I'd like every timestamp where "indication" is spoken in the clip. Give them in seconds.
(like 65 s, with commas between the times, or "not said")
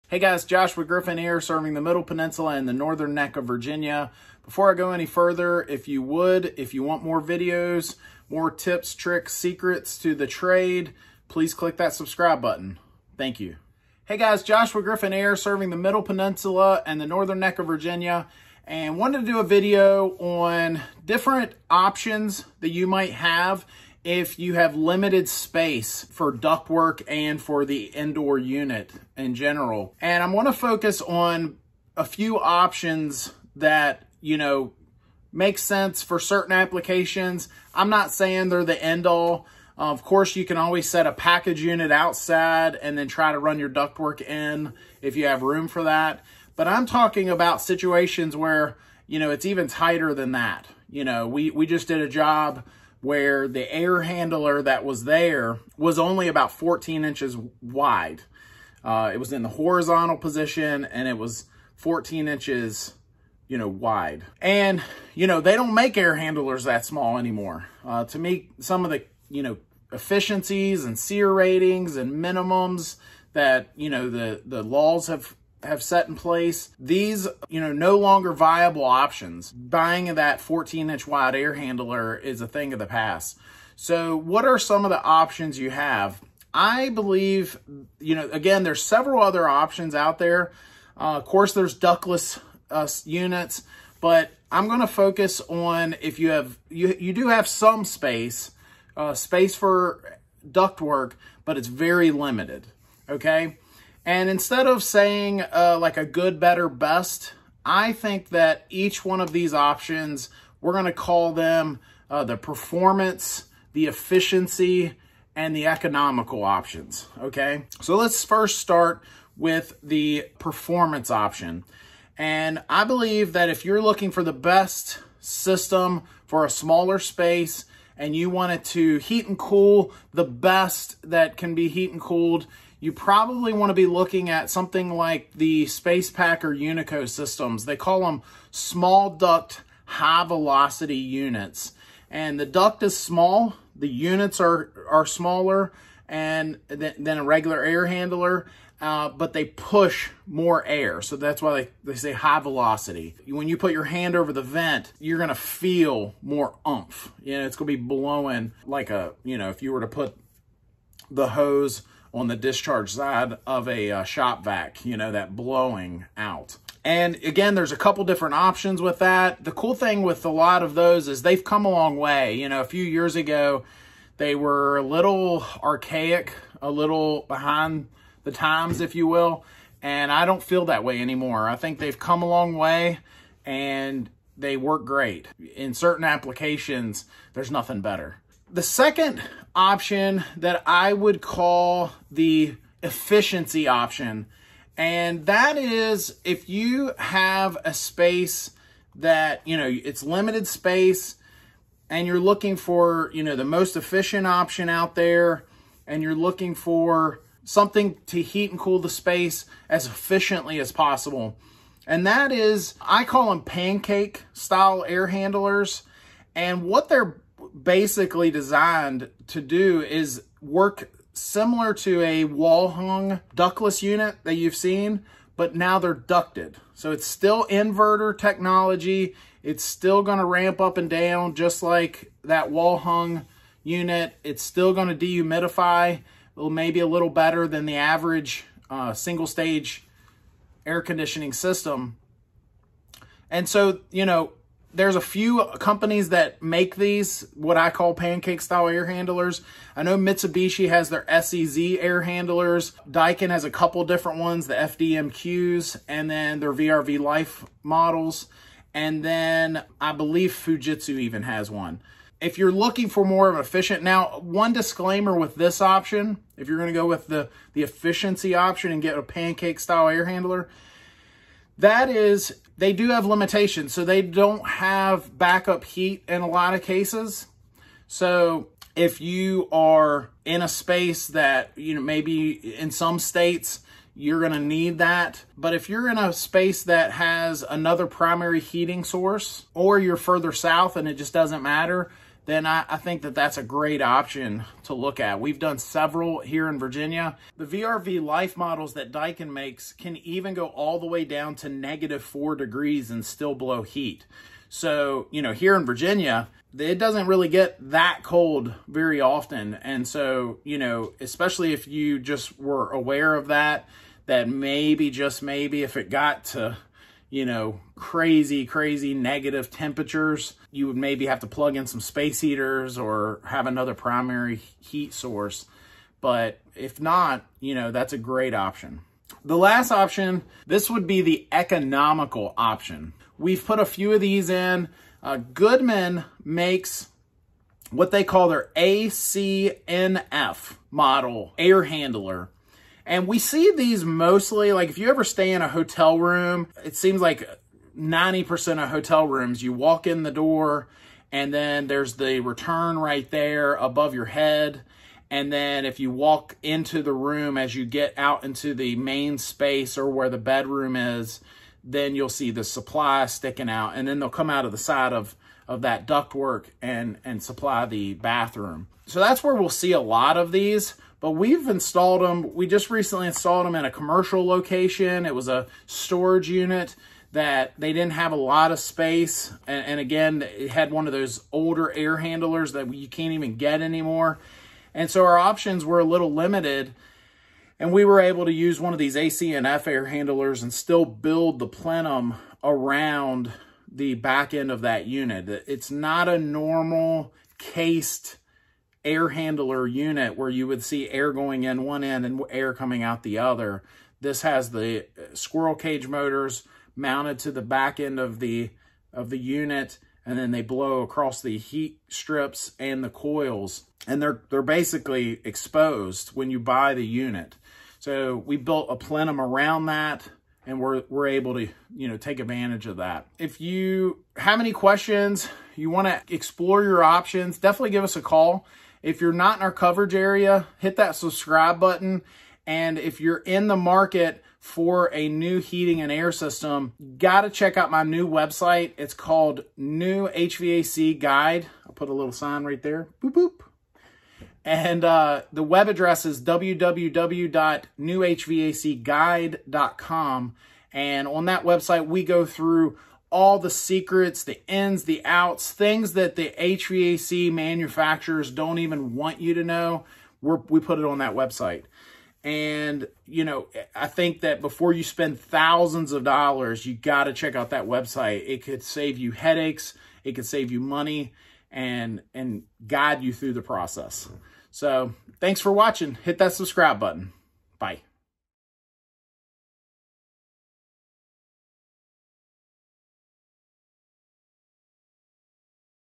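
not said.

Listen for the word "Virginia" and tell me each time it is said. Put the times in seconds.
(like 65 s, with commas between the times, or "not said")
3 s, 17 s, 296 s, 305 s.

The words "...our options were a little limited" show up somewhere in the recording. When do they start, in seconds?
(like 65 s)
385 s.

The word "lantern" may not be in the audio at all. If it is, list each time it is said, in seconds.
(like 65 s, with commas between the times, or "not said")
not said.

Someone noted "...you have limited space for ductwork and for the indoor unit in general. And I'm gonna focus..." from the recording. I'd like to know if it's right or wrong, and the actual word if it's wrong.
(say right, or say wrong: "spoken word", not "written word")
right.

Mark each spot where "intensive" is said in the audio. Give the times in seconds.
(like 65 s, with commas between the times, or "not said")
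not said.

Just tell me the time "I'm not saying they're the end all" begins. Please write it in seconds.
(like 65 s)
37 s.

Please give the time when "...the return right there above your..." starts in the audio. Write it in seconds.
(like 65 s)
351 s.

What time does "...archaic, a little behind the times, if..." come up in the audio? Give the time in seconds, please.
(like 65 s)
175 s.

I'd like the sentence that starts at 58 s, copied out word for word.
Uh, it was in the horizontal position and it was 14 inches, you know, wide.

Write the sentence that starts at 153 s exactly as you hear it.
When you put your hand over the vent, you're gonna feel more umph.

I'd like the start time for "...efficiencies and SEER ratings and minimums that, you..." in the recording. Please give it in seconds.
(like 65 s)
69 s.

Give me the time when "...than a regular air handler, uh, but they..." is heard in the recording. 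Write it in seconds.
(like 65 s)
146 s.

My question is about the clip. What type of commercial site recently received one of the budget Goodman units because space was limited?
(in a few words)
storage unit.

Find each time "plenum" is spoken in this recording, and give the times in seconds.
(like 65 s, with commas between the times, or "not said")
391 s, 418 s.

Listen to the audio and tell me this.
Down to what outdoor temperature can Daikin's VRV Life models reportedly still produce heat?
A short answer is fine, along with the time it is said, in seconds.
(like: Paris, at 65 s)
-4 degrees, at 301 s.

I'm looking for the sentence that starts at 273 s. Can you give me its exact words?
So they don't have backup heat in a lot of cases.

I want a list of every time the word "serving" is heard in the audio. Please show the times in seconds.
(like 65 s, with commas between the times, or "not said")
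1 s, 15 s.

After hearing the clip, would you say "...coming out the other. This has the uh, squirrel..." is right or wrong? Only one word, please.
right.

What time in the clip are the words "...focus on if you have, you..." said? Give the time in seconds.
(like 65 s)
94 s.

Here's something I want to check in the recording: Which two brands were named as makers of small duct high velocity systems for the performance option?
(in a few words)
SpacePak or Unico.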